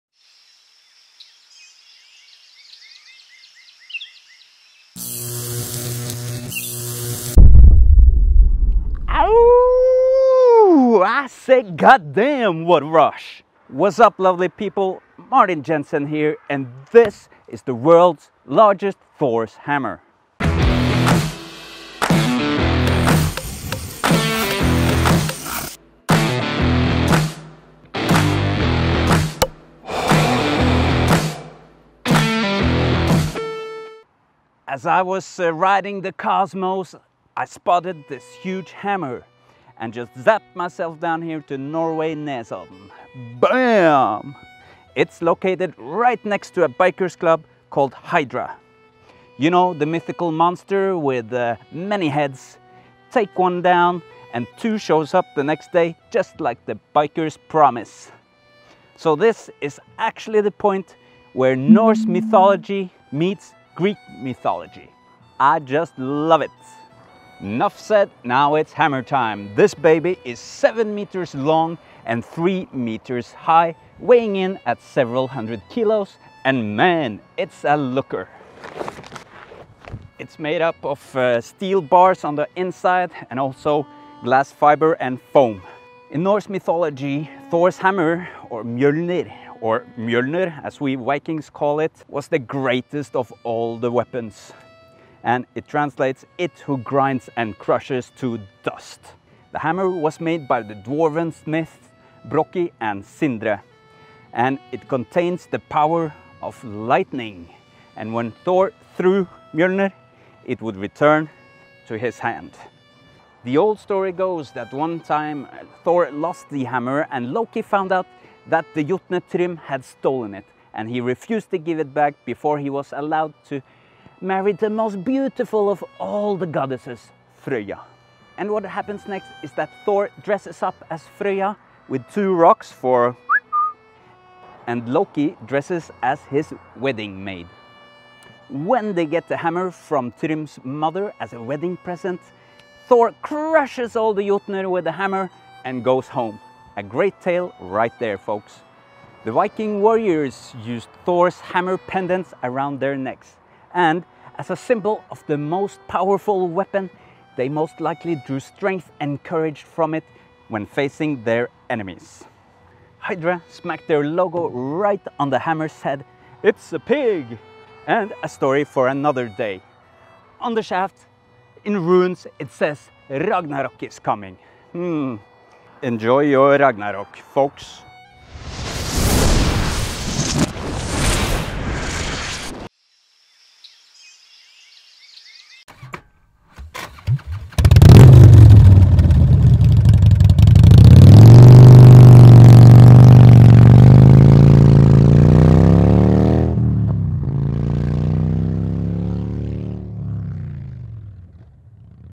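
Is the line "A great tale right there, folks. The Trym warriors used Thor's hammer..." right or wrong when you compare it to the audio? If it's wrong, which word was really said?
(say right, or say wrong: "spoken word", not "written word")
wrong: "Viking", not "Trym".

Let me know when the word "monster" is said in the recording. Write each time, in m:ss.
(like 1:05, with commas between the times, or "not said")
0:50.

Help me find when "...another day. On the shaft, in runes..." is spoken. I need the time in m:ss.
2:48.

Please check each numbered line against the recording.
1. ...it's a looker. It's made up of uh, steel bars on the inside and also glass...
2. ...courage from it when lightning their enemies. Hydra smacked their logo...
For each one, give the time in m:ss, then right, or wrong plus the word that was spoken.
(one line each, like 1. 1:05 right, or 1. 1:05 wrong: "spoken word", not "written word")
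1. 1:17 right
2. 2:39 wrong: "facing", not "lightning".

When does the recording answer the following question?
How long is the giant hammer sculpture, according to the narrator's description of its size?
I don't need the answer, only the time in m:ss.
1:10.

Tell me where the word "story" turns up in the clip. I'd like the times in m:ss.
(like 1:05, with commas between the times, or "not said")
1:53, 2:48.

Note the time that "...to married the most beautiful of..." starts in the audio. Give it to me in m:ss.
2:03.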